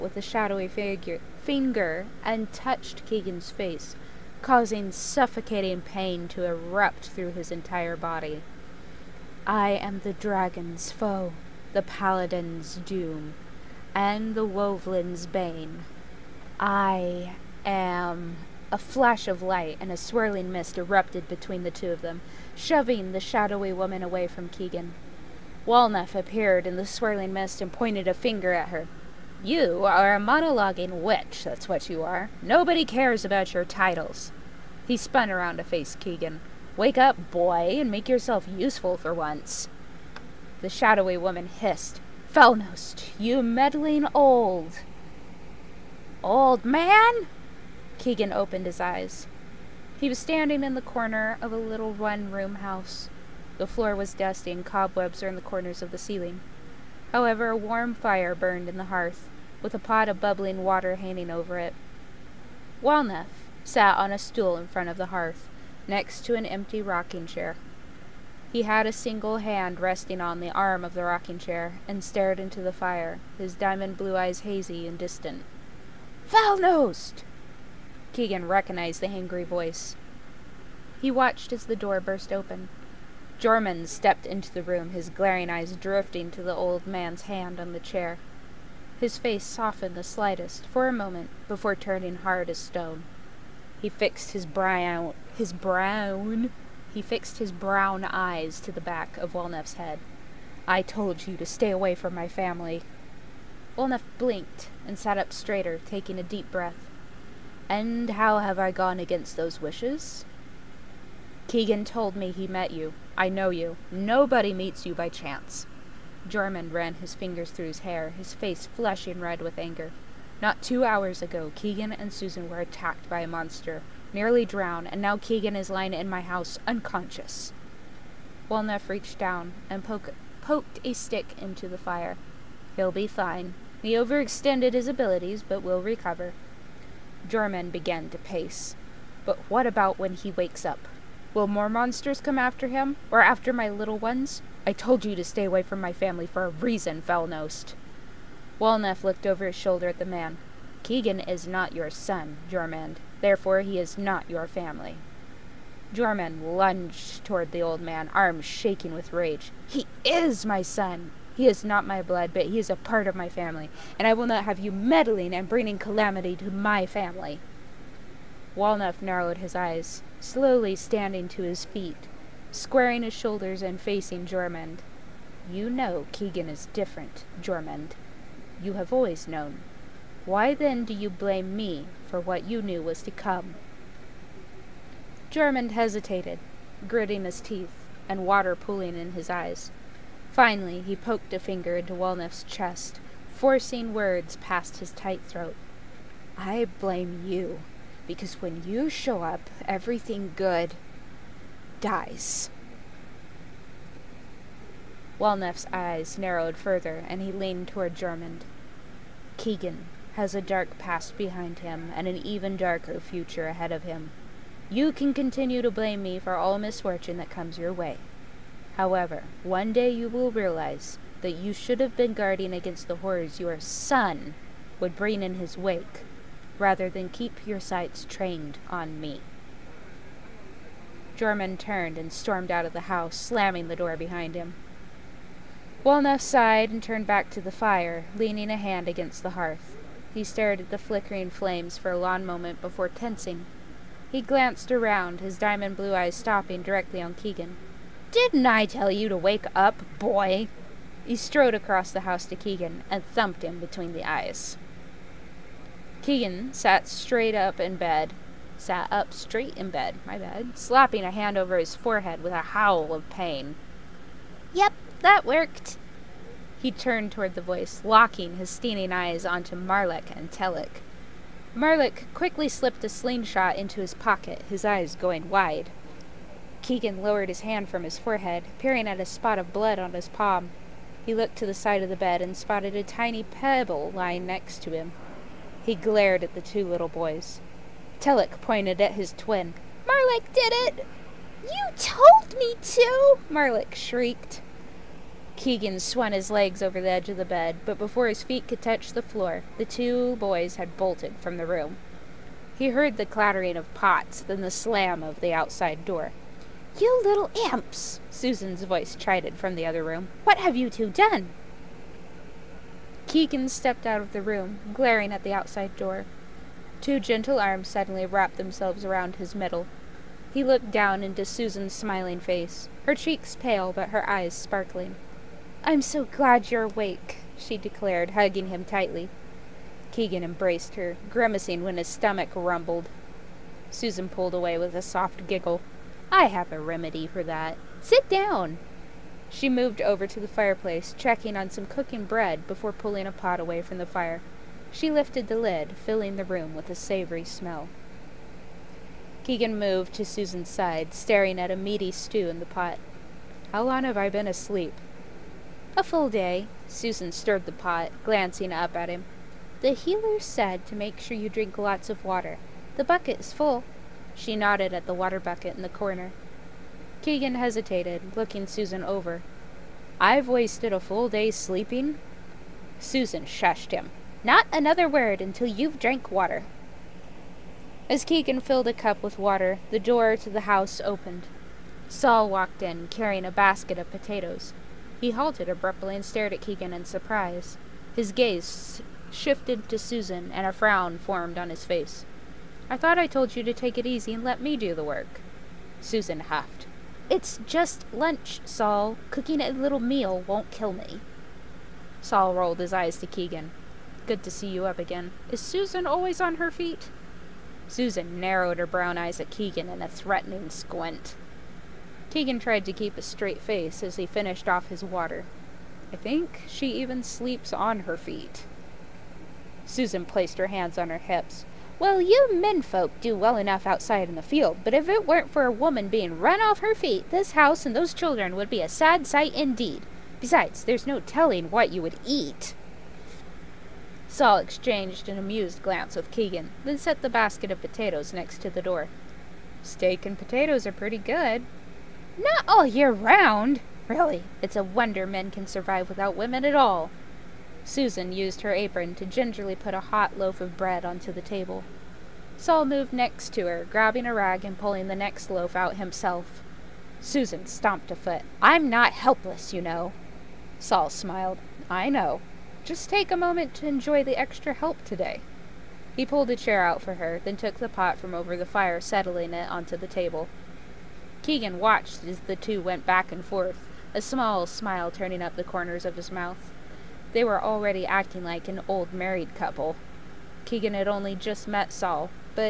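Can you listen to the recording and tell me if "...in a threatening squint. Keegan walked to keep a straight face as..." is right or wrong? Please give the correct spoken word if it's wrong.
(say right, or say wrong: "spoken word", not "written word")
wrong: "tried", not "walked".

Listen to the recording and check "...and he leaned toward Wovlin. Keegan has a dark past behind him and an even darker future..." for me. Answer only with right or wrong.
wrong.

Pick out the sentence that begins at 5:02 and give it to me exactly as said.
He heard the clattering of pots, then the slam of the outside door.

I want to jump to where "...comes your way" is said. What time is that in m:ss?
3:37.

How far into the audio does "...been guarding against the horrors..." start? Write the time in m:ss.
3:41.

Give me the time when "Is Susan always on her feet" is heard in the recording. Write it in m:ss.
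6:45.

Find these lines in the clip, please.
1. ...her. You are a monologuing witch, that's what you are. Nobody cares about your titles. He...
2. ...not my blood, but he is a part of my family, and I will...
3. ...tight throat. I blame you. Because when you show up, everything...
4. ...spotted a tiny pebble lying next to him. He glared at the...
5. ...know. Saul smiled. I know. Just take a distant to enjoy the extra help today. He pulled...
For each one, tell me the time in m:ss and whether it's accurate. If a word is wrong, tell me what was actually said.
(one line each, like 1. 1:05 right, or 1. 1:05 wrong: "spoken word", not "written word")
1. 0:28 right
2. 2:41 right
3. 3:14 right
4. 4:42 right
5. 7:39 wrong: "moment", not "distant".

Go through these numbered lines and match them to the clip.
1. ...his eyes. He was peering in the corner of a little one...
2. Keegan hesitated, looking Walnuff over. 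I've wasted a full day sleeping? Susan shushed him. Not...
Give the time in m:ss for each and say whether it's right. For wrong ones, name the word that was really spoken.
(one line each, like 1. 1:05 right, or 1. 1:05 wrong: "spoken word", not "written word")
1. 0:48 wrong: "standing", not "peering"
2. 6:07 wrong: "Susan", not "Walnuff".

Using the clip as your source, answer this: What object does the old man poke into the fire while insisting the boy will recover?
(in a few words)
A stick.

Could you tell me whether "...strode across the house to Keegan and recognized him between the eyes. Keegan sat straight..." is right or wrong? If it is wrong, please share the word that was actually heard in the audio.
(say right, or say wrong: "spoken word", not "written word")
wrong: "thumped", not "recognized".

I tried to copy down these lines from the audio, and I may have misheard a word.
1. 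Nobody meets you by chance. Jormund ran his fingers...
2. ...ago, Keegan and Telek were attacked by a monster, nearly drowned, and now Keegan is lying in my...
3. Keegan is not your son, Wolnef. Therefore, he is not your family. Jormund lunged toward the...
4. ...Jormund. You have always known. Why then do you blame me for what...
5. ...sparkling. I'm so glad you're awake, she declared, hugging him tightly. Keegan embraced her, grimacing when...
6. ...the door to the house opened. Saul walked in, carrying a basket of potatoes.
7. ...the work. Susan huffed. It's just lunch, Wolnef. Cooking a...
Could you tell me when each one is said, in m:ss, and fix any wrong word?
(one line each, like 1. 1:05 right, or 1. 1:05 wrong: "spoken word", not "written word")
1. 1:53 right
2. 2:01 wrong: "Susan", not "Telek"
3. 2:30 wrong: "Jormund", not "Wolnef"
4. 2:57 right
5. 5:24 right
6. 6:19 right
7. 6:34 wrong: "Saul", not "Wolnef".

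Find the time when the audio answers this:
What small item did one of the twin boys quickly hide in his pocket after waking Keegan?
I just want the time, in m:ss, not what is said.
4:32.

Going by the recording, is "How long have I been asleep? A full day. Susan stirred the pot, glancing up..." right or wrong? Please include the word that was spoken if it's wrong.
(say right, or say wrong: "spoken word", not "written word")
right.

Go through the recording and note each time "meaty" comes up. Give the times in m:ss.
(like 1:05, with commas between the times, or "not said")
5:51.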